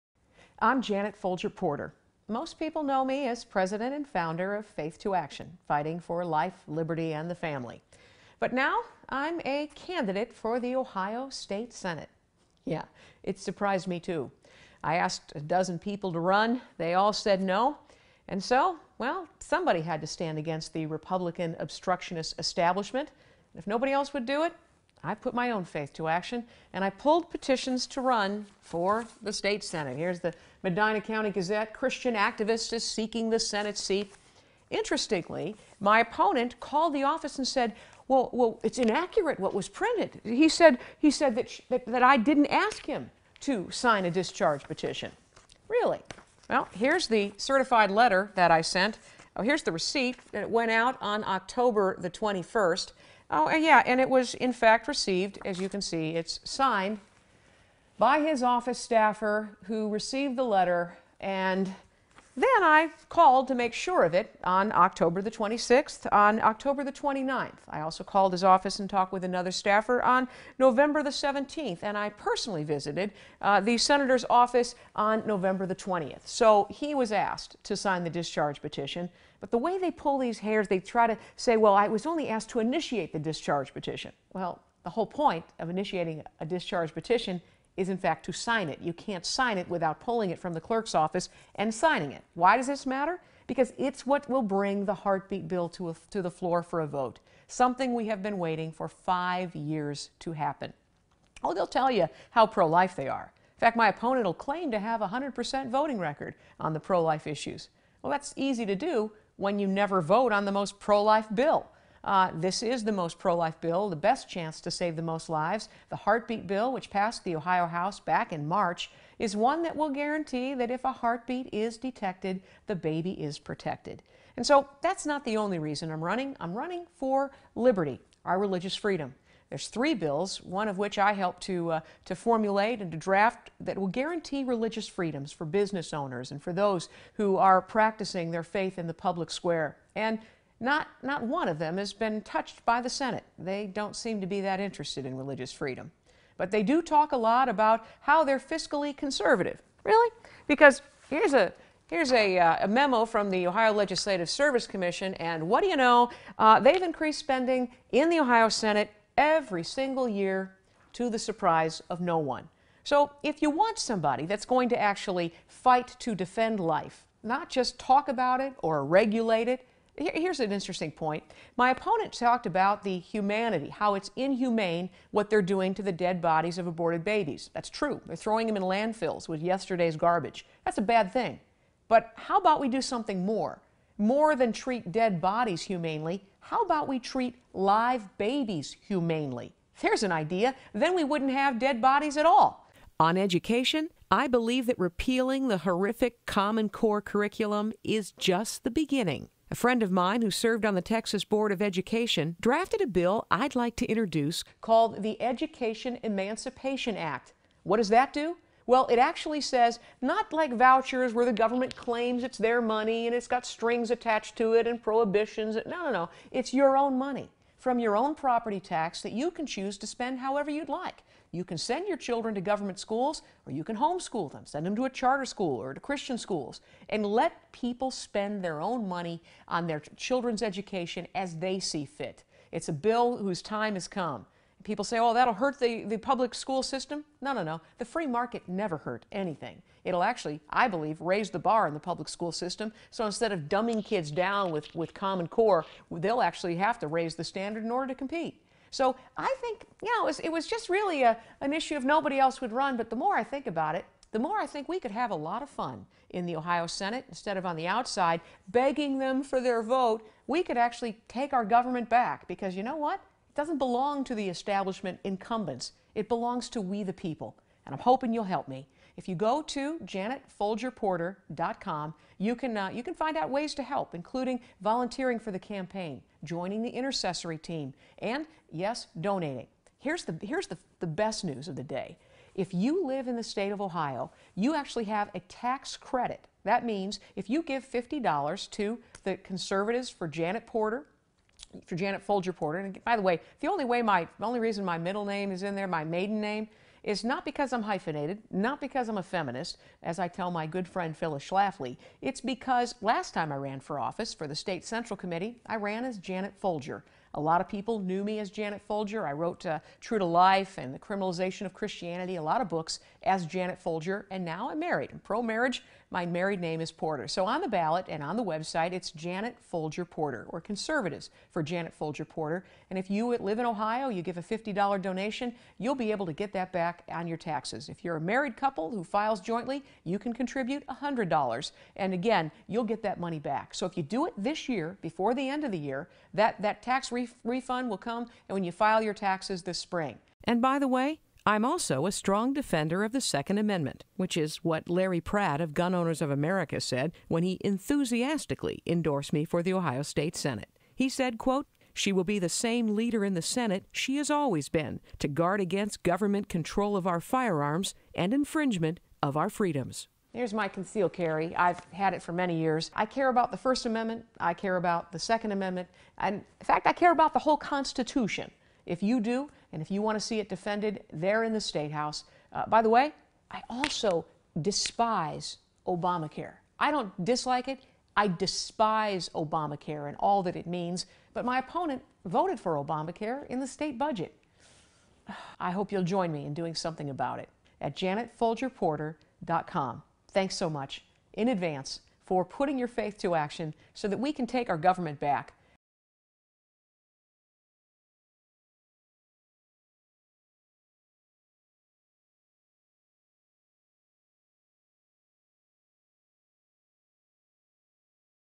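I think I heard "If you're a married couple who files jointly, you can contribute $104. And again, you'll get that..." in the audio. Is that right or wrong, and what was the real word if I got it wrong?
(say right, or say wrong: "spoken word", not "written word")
wrong: "100", not "104".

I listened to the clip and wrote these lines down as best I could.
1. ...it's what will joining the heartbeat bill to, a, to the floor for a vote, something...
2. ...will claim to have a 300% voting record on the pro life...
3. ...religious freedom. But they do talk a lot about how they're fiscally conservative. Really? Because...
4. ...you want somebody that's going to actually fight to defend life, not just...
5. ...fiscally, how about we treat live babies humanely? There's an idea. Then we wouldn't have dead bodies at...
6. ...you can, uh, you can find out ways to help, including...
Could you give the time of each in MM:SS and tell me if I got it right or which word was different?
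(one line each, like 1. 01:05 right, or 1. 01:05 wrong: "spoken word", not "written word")
1. 01:33 wrong: "bring", not "joining"
2. 01:44 wrong: "100", not "300"
3. 02:25 right
4. 02:43 right
5. 03:05 wrong: "humanely", not "fiscally"
6. 04:32 right.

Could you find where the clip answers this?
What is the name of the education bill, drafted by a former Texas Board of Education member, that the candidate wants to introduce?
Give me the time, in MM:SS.
03:25.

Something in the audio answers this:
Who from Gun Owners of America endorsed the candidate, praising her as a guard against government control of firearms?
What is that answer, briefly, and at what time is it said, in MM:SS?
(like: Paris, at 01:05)
Larry Pratt, at 05:44.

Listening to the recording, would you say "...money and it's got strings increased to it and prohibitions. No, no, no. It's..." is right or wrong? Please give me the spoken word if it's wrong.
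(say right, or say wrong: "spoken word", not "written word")
wrong: "attached", not "increased".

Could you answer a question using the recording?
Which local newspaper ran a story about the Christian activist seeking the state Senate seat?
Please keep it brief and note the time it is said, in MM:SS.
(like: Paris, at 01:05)
Medina County Gazette, at 00:30.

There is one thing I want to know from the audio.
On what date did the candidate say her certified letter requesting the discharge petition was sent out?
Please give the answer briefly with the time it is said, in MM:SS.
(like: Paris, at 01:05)
October 21, at 00:51.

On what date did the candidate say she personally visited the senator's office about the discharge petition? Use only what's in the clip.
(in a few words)
November 20.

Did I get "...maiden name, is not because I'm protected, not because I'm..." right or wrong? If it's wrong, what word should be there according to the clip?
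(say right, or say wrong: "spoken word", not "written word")
wrong: "hyphenated", not "protected".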